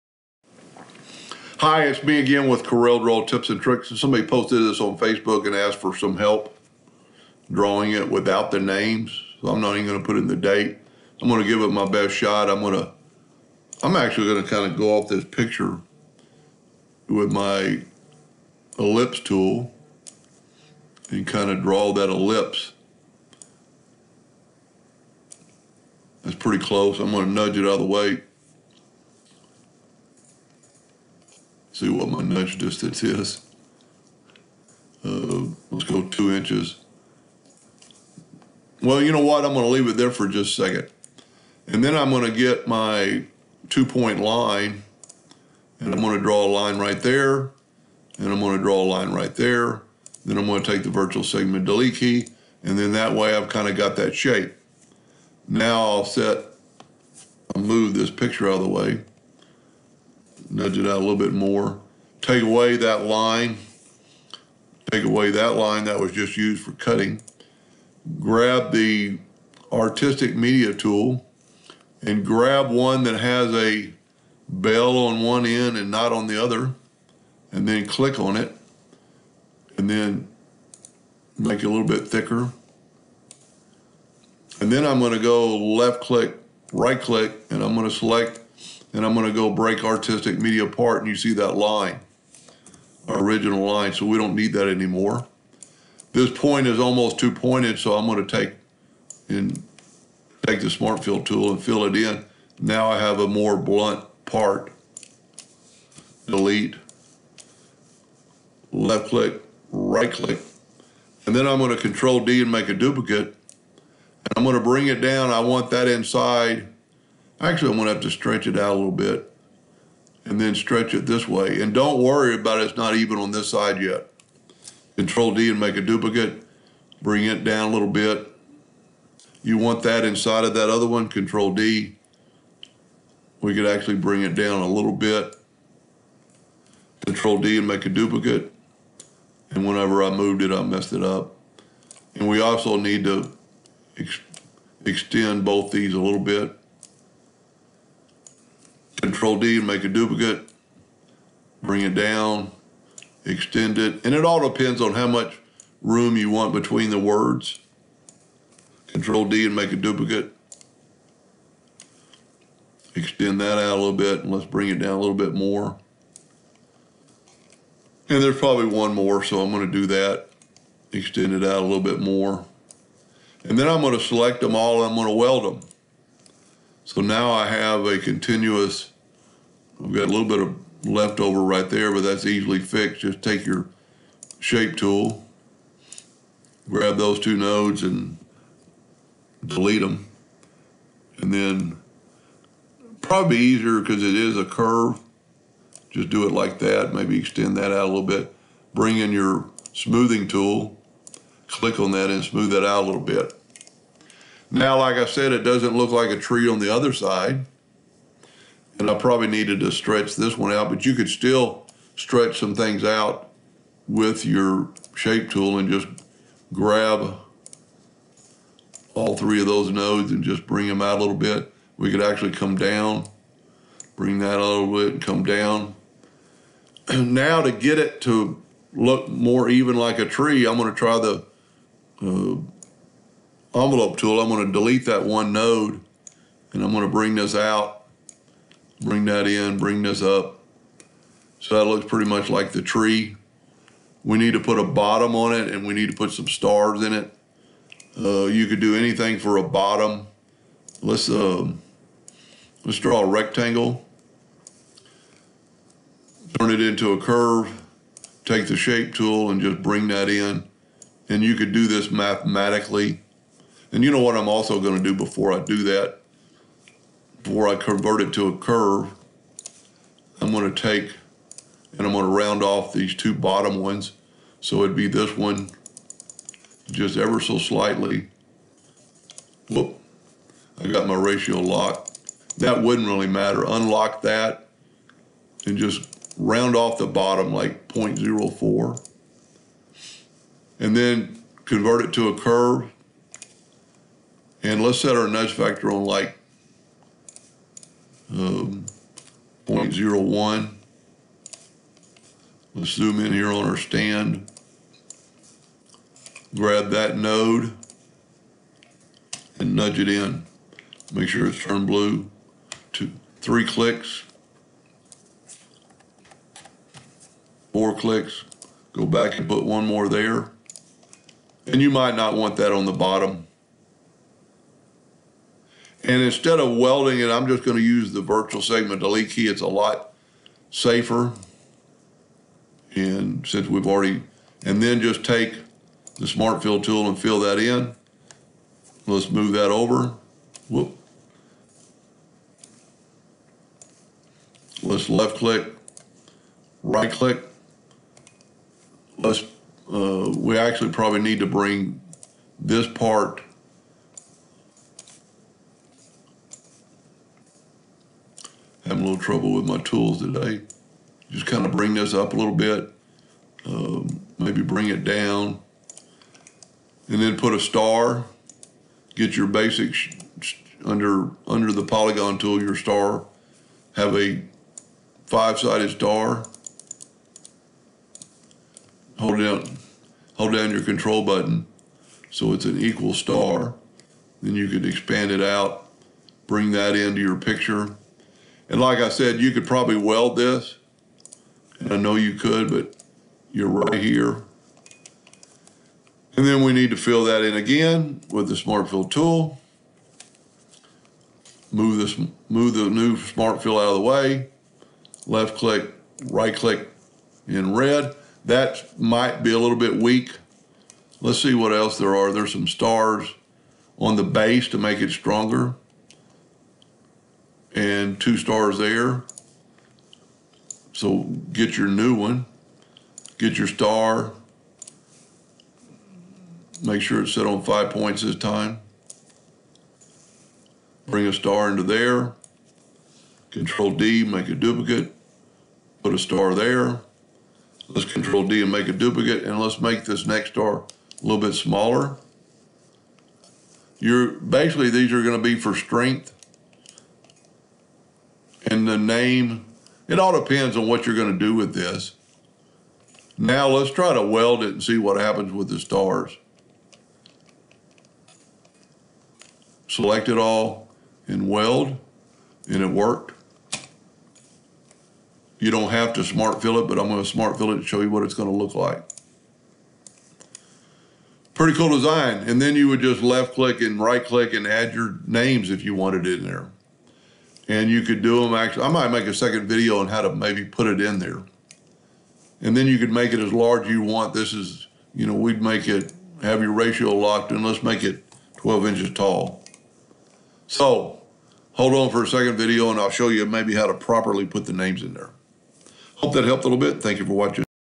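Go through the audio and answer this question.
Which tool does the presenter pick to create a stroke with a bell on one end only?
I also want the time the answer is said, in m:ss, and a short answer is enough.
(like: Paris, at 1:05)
artistic media tool, at 1:09.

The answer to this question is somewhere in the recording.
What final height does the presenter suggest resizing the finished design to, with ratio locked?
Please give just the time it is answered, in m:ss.
8:08.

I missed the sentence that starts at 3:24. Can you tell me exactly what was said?
Now, like I said, it doesn't look like a tree on the other side.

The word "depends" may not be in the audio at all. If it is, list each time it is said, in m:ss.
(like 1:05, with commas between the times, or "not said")
2:34, 7:30.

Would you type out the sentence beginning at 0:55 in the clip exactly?
Now I'll set, I'll move this picture out of the way nudge it out a little bit more.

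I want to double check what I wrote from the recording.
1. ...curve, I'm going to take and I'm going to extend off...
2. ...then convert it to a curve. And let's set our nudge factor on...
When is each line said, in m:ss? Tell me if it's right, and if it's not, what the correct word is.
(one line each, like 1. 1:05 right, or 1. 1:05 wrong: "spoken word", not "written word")
1. 4:28 wrong: "round", not "extend"
2. 4:50 right.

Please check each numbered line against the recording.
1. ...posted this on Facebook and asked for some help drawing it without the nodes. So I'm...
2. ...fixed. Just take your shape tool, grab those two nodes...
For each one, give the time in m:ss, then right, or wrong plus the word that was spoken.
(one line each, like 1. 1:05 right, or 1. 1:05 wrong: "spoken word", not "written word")
1. 0:04 wrong: "names", not "nodes"
2. 3:02 right.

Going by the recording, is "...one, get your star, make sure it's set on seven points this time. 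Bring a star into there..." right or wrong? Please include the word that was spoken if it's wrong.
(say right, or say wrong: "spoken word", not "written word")
wrong: "five", not "seven".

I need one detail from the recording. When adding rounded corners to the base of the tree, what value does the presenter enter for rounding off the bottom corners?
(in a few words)
0.04.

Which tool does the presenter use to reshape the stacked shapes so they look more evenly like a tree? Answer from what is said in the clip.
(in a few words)
envelope tool.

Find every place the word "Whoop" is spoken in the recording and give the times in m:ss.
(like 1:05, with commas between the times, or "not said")
4:39, 5:40.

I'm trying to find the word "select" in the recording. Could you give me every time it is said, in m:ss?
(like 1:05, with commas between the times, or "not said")
1:27, 2:53, 7:39.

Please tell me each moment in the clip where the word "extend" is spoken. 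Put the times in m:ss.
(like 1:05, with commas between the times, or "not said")
2:24, 2:33, 2:42, 2:50, 3:17.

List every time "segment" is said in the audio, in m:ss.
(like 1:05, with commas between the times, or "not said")
0:51, 5:28.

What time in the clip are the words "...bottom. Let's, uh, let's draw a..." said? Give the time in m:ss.
4:09.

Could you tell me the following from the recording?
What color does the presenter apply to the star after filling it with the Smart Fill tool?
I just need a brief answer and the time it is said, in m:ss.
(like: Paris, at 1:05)
red, at 6:47.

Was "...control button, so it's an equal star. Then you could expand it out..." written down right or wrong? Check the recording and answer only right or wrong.
right.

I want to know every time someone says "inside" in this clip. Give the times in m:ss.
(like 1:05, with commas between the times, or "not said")
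1:55, 2:10.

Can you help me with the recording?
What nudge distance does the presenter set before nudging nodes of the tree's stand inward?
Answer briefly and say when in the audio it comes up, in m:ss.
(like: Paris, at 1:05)
0.01, at 4:59.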